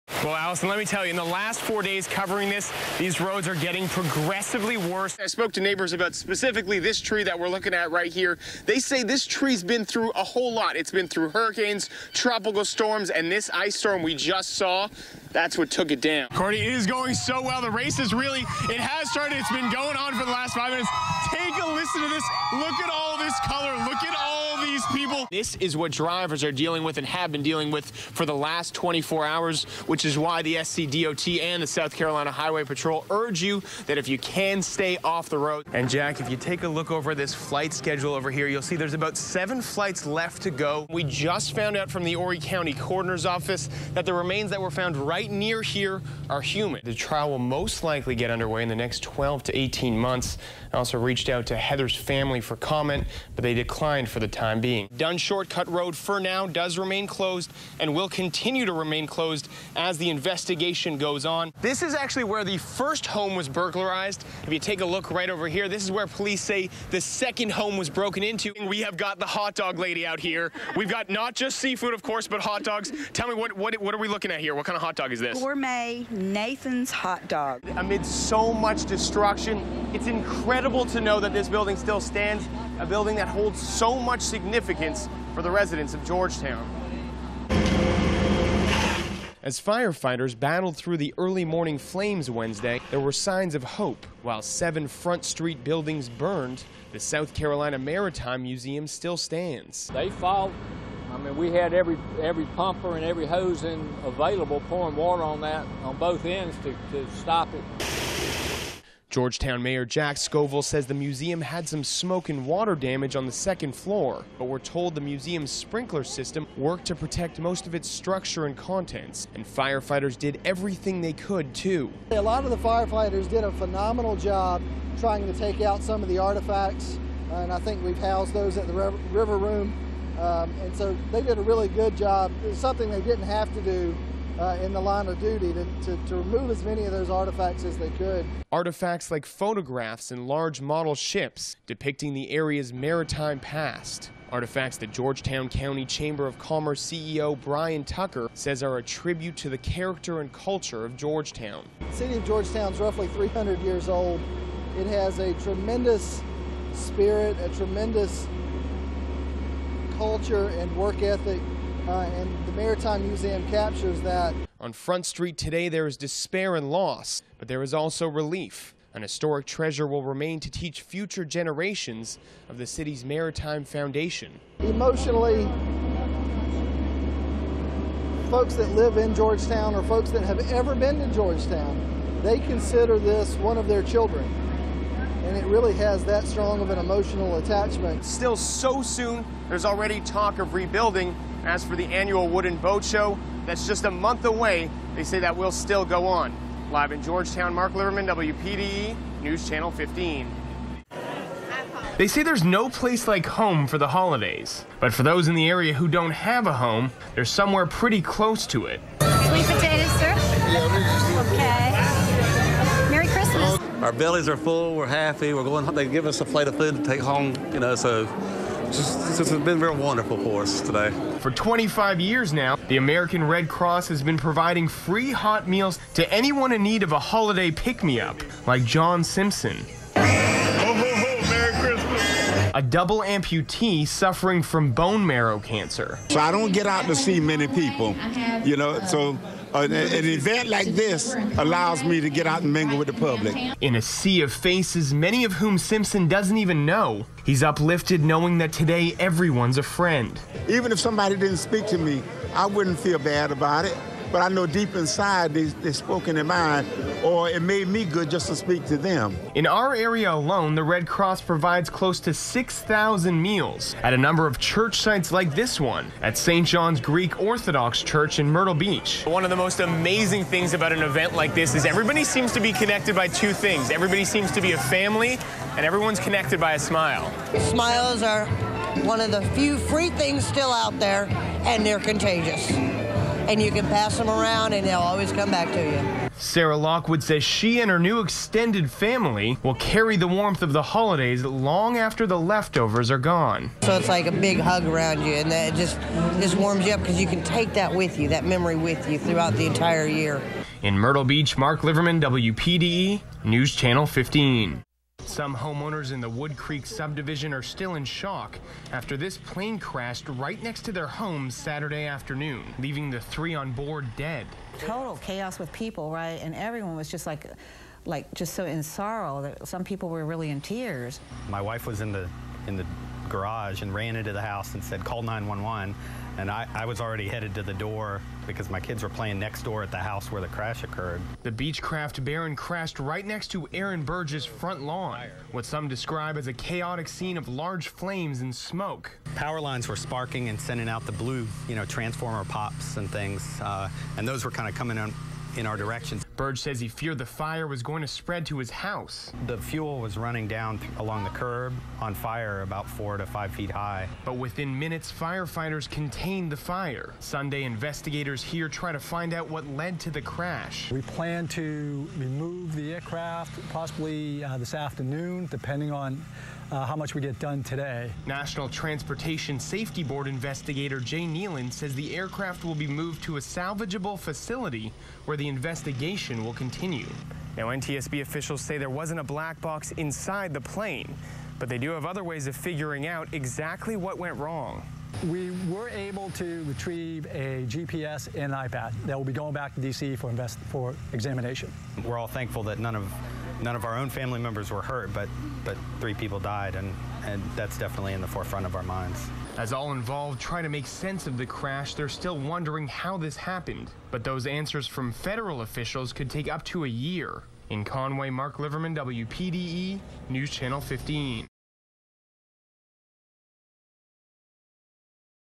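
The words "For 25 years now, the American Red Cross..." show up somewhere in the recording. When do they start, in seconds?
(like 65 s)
221 s.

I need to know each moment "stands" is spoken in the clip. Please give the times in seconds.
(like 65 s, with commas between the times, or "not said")
82 s, 99 s.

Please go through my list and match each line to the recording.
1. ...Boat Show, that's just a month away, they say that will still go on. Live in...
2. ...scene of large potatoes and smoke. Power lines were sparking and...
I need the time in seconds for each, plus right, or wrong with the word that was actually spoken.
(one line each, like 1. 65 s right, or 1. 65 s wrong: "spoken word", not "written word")
1. 192 s right
2. 336 s wrong: "flames", not "potatoes".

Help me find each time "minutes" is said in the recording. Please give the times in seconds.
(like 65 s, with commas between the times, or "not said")
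20 s, 354 s.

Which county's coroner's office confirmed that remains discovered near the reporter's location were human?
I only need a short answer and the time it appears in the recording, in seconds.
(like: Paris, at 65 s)
Horry County, at 42 s.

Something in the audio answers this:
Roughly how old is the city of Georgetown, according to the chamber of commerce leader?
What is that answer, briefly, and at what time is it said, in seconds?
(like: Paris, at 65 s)
300 years, at 153 s.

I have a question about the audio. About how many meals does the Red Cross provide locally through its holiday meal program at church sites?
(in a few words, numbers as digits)
6,000.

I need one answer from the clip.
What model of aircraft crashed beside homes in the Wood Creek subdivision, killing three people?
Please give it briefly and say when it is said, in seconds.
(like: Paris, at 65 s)
Beechcraft Baron, at 331 s.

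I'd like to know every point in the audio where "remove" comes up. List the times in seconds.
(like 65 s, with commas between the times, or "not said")
136 s, 361 s.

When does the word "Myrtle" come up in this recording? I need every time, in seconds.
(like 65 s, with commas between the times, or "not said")
268 s, 300 s.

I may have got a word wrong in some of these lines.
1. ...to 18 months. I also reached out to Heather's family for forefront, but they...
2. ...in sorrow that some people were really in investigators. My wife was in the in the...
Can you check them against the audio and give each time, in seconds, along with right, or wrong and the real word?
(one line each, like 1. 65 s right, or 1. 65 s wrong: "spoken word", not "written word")
1. 49 s wrong: "comment", not "forefront"
2. 318 s wrong: "tears", not "investigators".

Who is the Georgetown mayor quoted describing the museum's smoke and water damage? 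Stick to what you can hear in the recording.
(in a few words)
Jack Scoville.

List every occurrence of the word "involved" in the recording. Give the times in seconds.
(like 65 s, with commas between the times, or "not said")
399 s.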